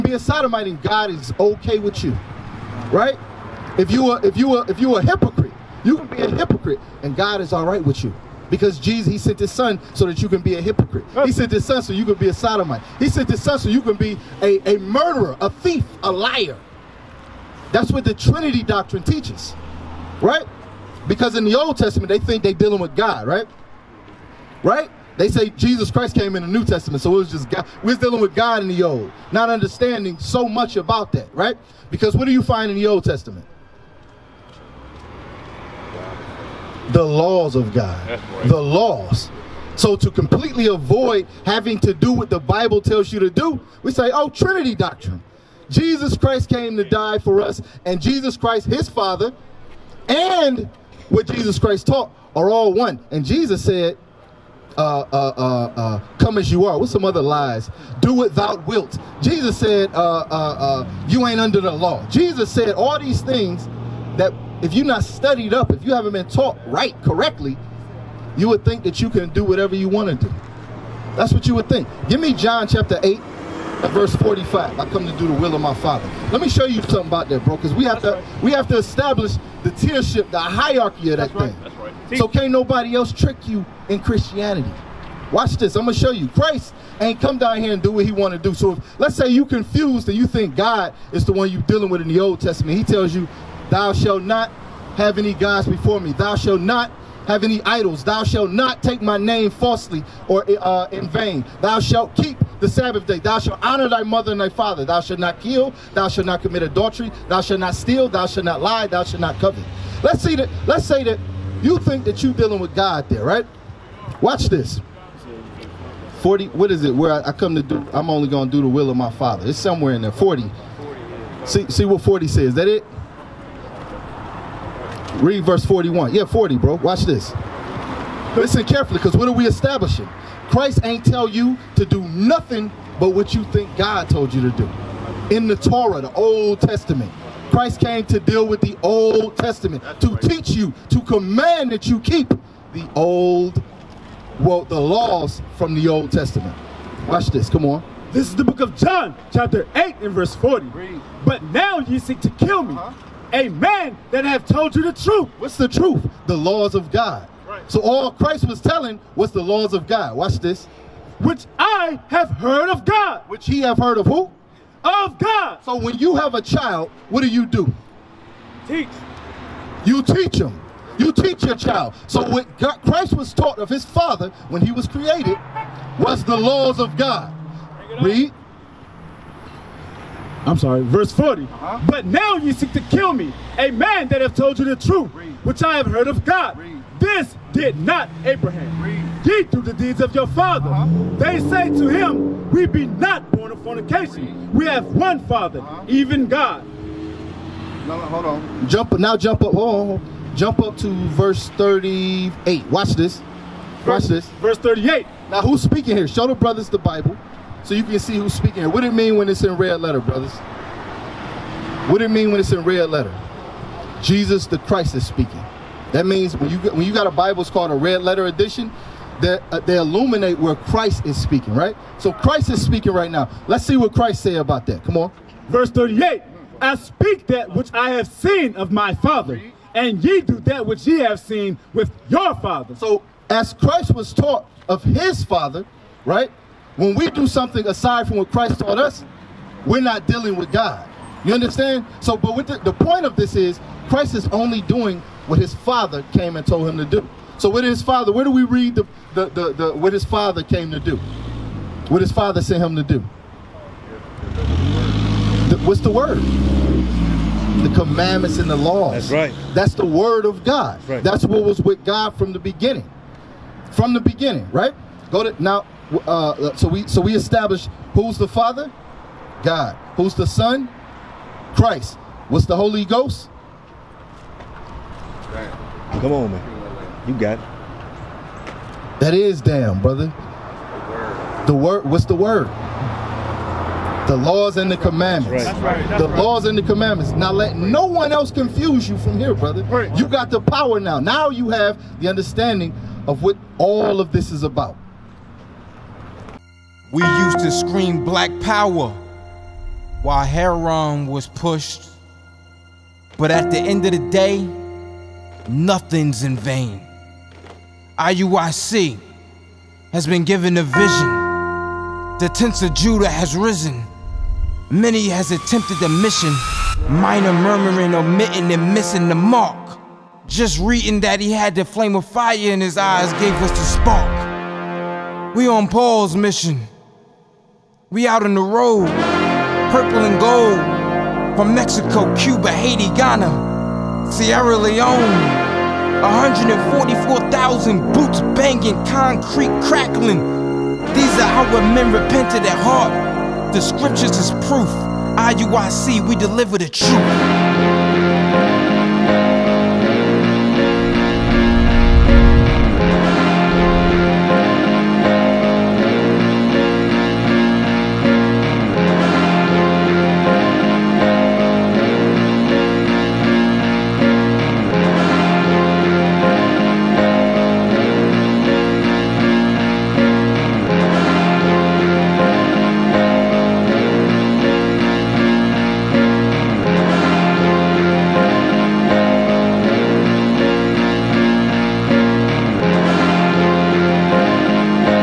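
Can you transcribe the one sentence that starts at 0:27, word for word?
We're dealing with God in the Old, not understanding so much about that, right?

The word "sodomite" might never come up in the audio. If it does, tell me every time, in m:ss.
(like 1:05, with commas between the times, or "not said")
0:00, 0:12.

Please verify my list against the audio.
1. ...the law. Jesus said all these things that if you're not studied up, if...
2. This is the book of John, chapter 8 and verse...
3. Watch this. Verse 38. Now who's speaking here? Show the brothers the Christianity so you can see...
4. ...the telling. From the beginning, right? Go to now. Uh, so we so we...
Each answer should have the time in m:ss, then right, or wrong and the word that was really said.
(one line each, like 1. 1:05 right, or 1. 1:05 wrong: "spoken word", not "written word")
1. 1:01 right
2. 2:28 right
3. 3:23 wrong: "Bible", not "Christianity"
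4. 4:22 wrong: "beginning", not "telling".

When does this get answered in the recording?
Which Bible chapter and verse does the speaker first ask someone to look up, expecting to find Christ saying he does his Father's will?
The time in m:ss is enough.
1:12.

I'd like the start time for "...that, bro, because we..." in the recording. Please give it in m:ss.
1:17.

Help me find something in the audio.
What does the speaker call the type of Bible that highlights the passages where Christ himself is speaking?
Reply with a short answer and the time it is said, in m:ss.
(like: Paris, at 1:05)
red letter edition, at 3:37.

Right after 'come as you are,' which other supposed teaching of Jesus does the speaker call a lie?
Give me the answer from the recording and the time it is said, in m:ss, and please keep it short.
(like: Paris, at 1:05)
Do what thou wilt, at 0:57.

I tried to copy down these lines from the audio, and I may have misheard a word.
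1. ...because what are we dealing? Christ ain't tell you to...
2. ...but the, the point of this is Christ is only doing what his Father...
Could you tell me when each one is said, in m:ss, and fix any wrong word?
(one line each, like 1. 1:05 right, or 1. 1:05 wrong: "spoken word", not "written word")
1. 2:08 wrong: "establishing", not "dealing"
2. 4:02 right.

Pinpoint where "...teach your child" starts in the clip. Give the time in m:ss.
2:51.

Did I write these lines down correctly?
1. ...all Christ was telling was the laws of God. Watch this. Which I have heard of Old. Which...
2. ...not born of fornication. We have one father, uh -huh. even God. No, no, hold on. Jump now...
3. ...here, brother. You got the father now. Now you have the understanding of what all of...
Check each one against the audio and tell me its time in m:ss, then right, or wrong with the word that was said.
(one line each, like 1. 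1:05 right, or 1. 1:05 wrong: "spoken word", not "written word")
1. 2:37 wrong: "God", not "Old"
2. 3:12 right
3. 4:49 wrong: "power", not "father".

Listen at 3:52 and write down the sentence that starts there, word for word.
So as Christ was taught of his Father, right?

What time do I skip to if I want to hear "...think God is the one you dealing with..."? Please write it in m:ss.
1:30.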